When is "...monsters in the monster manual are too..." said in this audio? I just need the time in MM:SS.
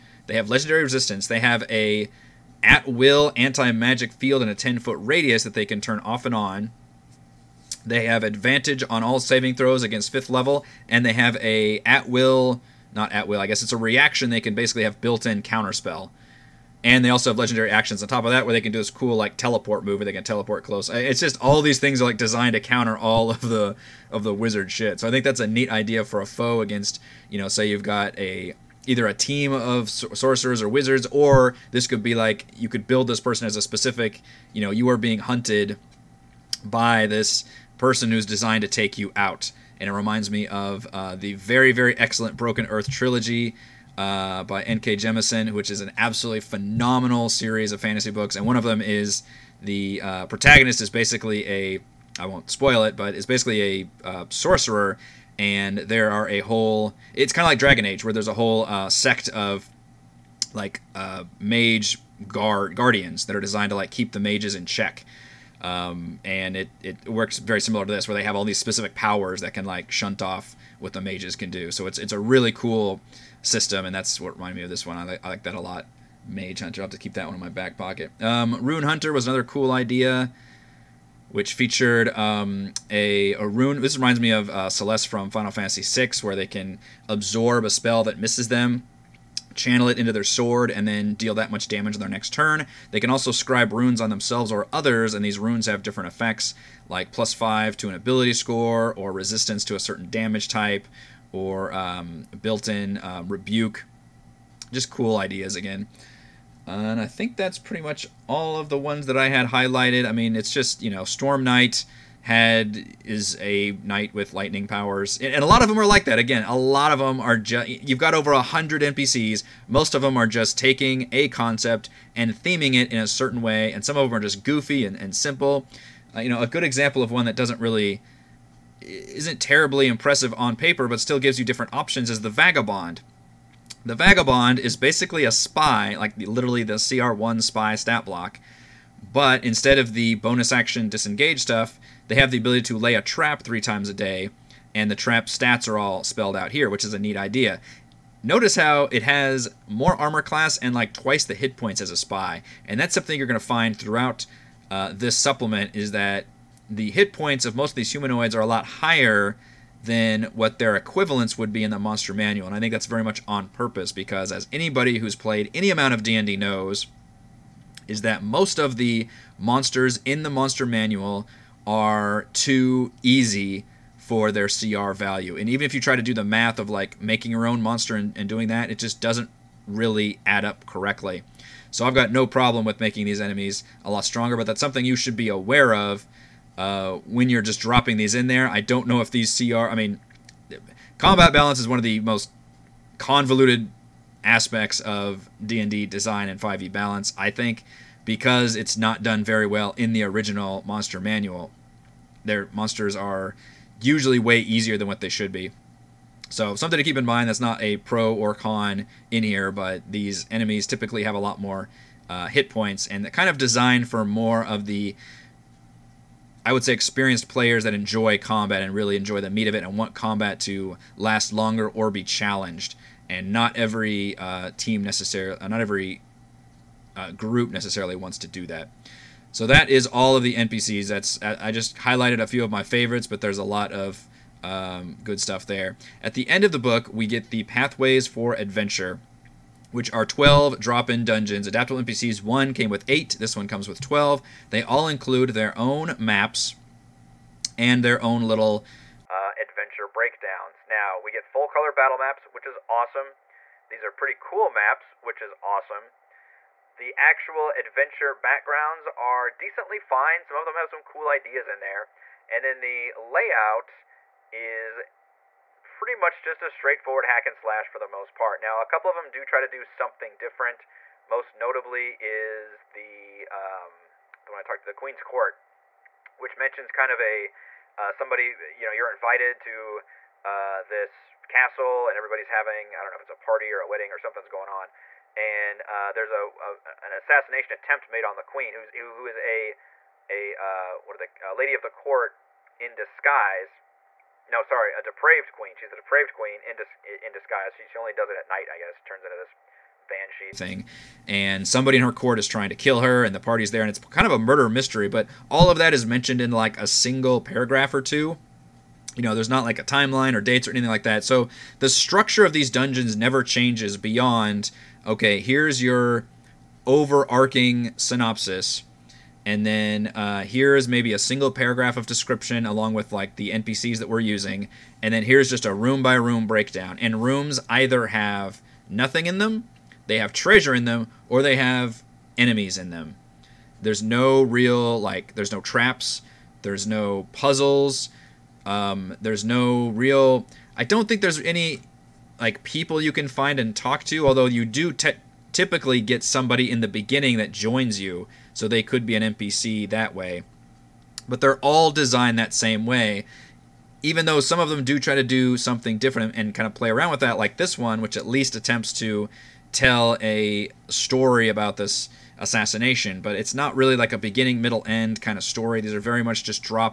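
02:49.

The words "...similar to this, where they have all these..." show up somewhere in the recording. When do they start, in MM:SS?
01:07.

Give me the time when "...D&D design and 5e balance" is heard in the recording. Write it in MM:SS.
03:15.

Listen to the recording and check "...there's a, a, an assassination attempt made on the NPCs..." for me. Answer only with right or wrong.
wrong.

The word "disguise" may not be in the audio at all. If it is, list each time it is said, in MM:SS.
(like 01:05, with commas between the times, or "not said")
04:52, 04:57.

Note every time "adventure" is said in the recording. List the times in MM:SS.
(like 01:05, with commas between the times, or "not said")
03:58, 04:09, 04:17.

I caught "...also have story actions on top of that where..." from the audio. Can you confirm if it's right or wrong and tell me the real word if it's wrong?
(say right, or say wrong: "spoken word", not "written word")
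wrong: "legendary", not "story".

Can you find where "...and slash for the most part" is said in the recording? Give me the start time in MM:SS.
04:27.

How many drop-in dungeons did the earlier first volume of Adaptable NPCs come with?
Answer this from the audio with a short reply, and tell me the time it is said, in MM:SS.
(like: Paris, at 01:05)
8, at 04:02.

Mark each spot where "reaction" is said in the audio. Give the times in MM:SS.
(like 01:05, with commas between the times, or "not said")
00:13.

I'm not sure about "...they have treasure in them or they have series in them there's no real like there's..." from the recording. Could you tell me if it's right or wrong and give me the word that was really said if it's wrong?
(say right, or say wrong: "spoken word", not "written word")
wrong: "enemies", not "series".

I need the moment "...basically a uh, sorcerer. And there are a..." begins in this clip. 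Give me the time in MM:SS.
00:53.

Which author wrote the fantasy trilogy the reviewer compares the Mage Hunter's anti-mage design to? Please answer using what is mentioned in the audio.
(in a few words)
N.K. Jemisin.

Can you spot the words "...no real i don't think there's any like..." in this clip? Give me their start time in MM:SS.
05:39.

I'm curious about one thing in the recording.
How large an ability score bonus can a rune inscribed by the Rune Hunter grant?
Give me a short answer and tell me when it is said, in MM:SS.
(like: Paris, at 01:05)
+5, at 01:37.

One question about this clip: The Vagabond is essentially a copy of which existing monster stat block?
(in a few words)
CR1 spy.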